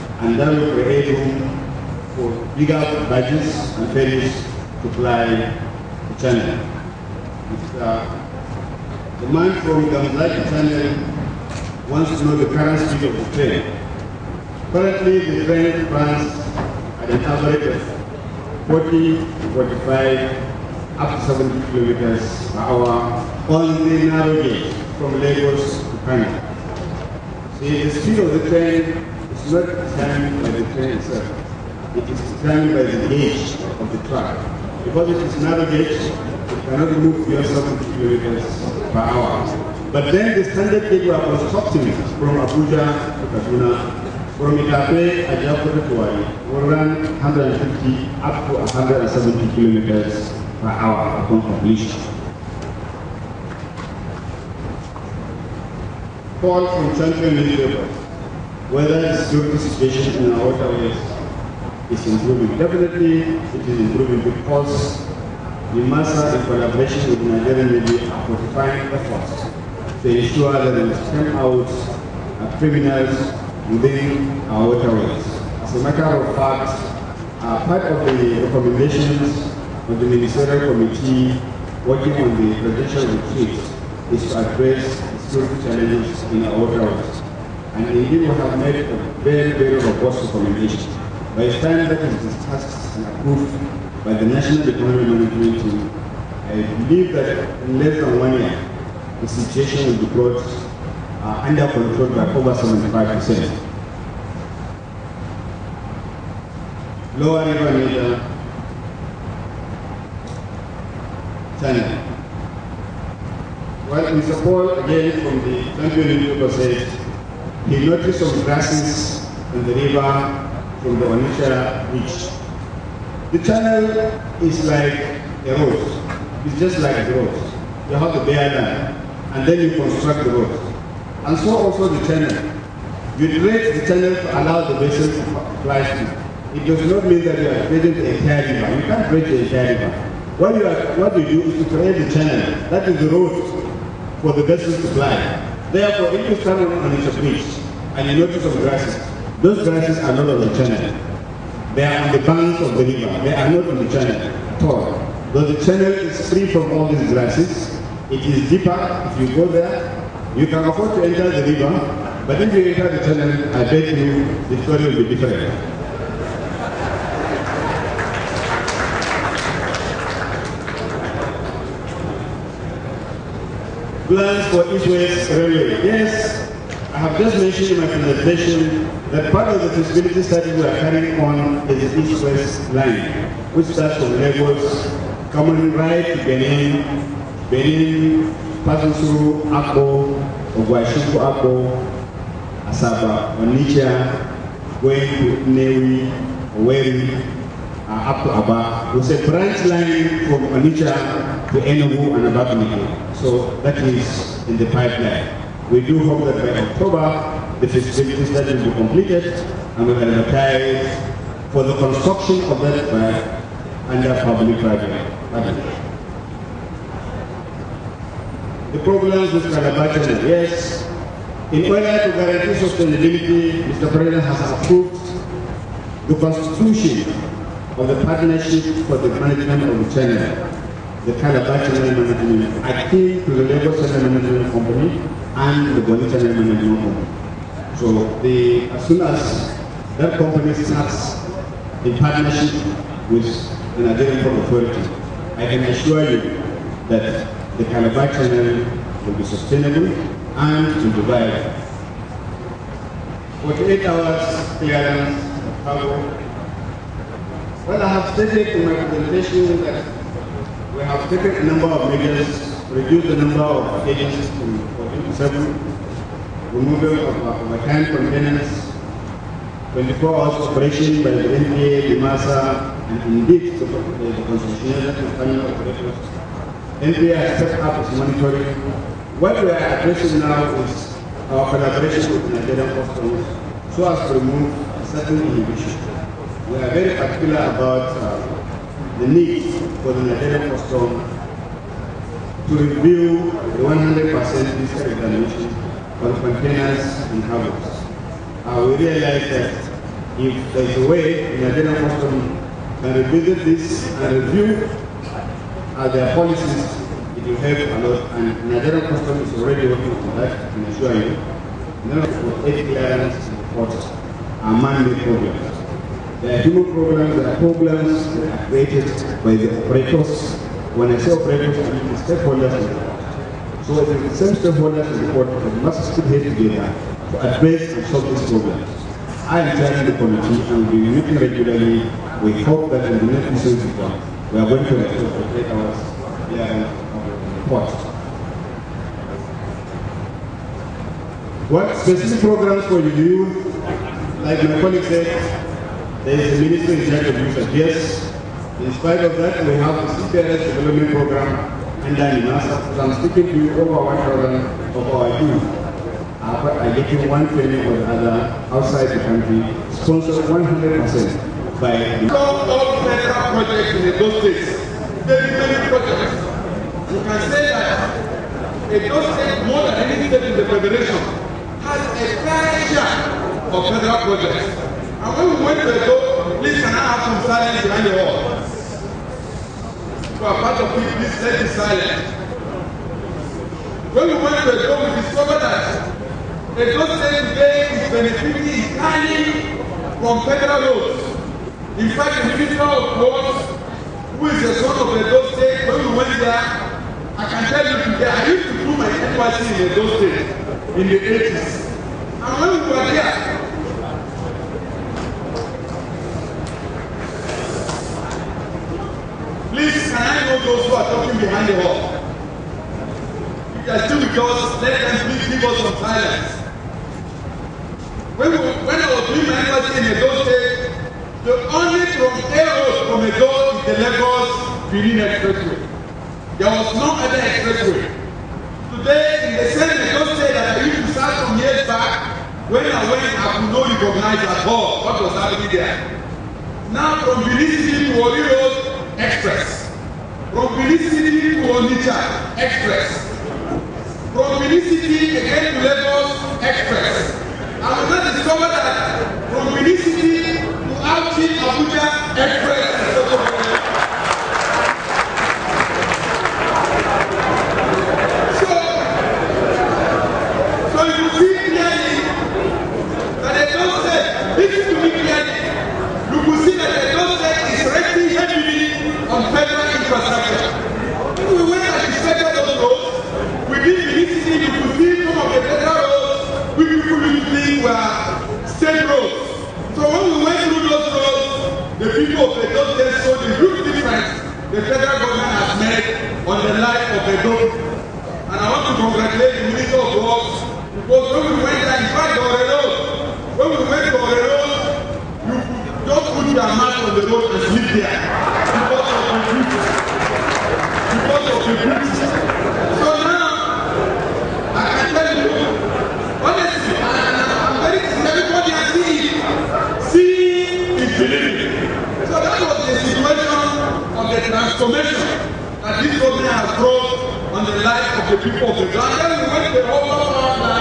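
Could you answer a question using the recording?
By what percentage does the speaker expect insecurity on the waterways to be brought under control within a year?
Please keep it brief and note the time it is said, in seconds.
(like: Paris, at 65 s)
75%, at 102 s.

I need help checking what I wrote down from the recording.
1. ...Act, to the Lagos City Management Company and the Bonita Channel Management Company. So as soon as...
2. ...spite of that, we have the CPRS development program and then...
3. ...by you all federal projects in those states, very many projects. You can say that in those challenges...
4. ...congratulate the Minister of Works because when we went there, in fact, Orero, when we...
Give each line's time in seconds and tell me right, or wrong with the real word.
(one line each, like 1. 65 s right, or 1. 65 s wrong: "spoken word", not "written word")
1. 232 s wrong: "Channel", not "City"
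2. 348 s right
3. 361 s wrong: "states", not "challenges"
4. 488 s right.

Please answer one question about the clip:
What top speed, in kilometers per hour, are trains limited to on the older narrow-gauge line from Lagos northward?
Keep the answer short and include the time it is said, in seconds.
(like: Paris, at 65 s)
70, at 36 s.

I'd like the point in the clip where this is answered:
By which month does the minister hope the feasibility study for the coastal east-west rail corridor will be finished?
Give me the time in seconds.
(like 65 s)
206 s.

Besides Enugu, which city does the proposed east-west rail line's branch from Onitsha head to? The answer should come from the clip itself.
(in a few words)
Abakaliki.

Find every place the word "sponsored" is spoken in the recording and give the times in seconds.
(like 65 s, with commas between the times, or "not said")
359 s.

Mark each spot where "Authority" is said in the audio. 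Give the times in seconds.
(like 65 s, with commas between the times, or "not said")
244 s.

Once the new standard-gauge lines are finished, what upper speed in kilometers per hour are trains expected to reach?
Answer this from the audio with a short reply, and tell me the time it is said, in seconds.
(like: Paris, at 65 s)
170, at 47 s.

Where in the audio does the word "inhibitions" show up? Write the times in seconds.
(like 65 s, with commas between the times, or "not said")
285 s.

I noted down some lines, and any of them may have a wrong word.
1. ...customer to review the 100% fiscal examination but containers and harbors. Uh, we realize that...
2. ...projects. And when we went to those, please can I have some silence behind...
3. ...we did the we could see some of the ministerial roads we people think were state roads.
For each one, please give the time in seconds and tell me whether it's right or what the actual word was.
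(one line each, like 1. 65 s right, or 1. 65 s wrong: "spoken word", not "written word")
1. 290 s right
2. 374 s right
3. 473 s wrong: "federal", not "ministerial".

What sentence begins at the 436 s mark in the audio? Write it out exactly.
Now, from Benin City to Warri Road, Express.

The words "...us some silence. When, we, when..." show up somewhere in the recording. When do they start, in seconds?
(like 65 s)
415 s.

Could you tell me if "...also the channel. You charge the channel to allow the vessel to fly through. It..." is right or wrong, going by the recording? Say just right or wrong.
wrong.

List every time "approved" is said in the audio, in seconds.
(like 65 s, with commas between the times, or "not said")
93 s, 224 s.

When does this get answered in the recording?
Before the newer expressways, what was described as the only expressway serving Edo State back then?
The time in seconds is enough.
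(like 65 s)
423 s.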